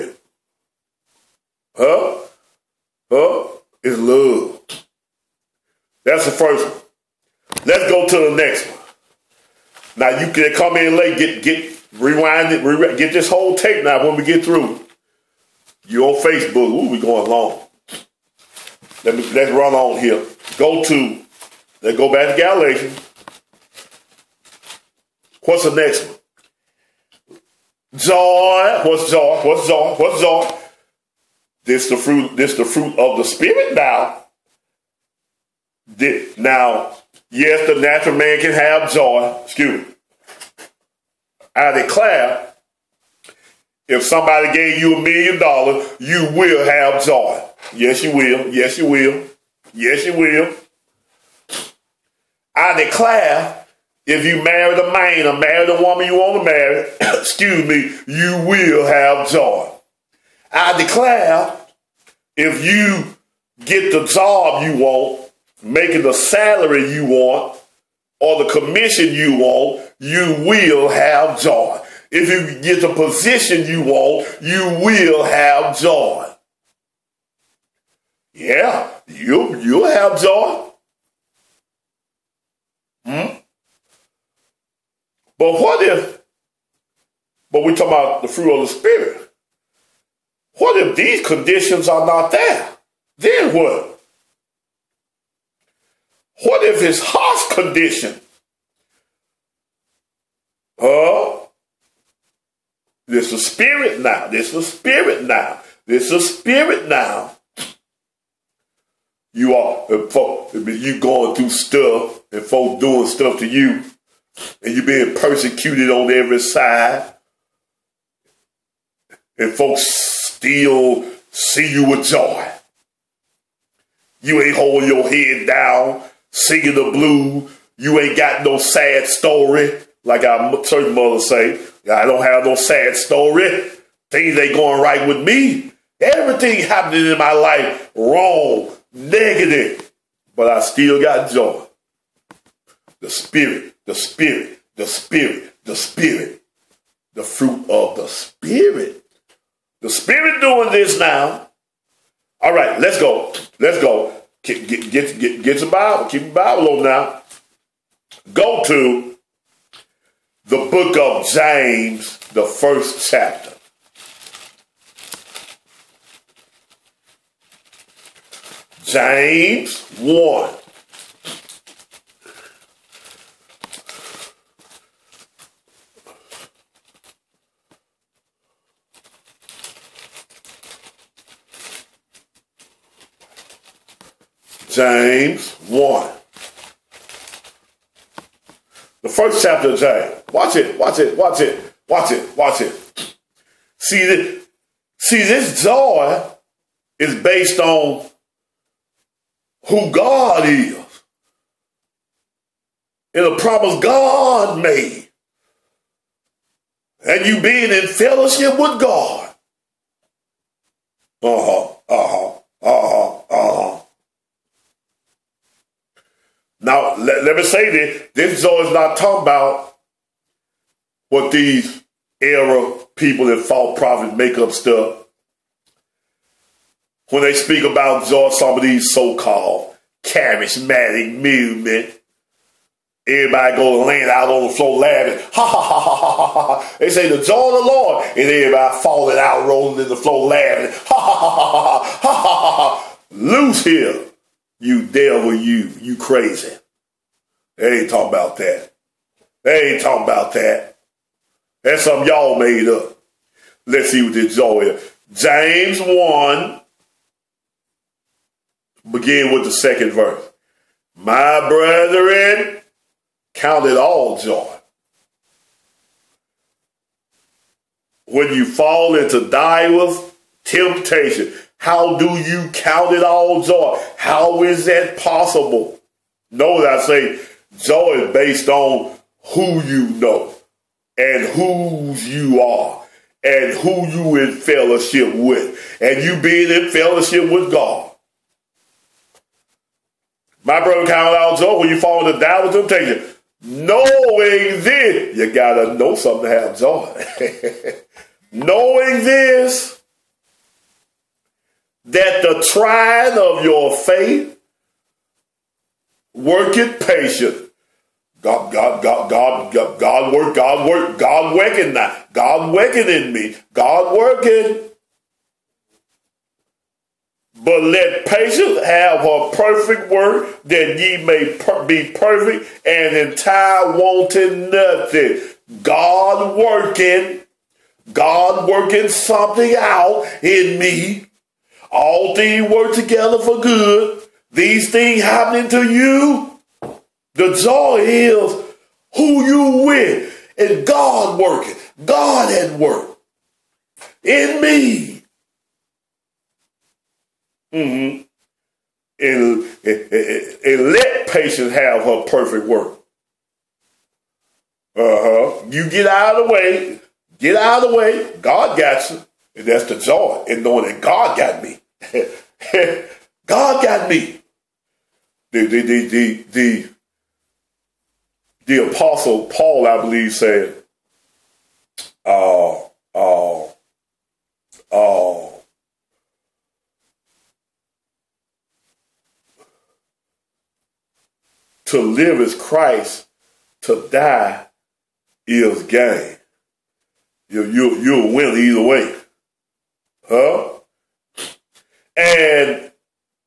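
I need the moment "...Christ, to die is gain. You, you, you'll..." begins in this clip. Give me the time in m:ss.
6:22.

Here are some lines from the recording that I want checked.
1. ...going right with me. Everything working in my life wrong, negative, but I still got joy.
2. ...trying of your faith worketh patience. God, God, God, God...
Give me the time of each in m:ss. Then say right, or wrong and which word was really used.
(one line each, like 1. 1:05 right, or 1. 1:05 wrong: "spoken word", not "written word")
1. 2:14 wrong: "happening", not "working"
2. 5:02 right.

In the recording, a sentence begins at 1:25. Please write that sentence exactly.
But what if, but we talk about the fruit of the Spirit.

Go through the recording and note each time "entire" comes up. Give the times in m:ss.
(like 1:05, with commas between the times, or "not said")
5:22.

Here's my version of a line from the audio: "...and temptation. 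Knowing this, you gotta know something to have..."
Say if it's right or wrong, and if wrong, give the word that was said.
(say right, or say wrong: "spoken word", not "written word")
right.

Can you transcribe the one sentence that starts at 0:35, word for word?
This, now, yes, the natural man can have joy.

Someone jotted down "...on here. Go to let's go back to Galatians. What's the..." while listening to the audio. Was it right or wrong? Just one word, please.
right.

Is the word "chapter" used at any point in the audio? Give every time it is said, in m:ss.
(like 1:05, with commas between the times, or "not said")
2:43, 3:09.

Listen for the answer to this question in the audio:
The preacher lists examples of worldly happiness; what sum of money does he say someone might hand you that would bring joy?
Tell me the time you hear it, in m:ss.
0:44.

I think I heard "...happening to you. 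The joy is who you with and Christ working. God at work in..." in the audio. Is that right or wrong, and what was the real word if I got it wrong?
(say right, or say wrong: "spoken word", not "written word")
wrong: "God", not "Christ".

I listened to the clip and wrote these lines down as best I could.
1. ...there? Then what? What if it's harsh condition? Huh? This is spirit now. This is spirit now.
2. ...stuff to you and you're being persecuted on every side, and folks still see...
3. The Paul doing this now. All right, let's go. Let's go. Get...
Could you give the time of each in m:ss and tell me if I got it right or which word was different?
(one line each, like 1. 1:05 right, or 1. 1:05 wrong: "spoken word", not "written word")
1. 1:32 right
2. 1:53 right
3. 2:29 wrong: "Spirit", not "Paul".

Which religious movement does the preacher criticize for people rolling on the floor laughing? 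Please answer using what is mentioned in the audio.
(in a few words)
charismatic movement.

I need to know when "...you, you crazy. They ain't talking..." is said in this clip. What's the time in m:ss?
4:05.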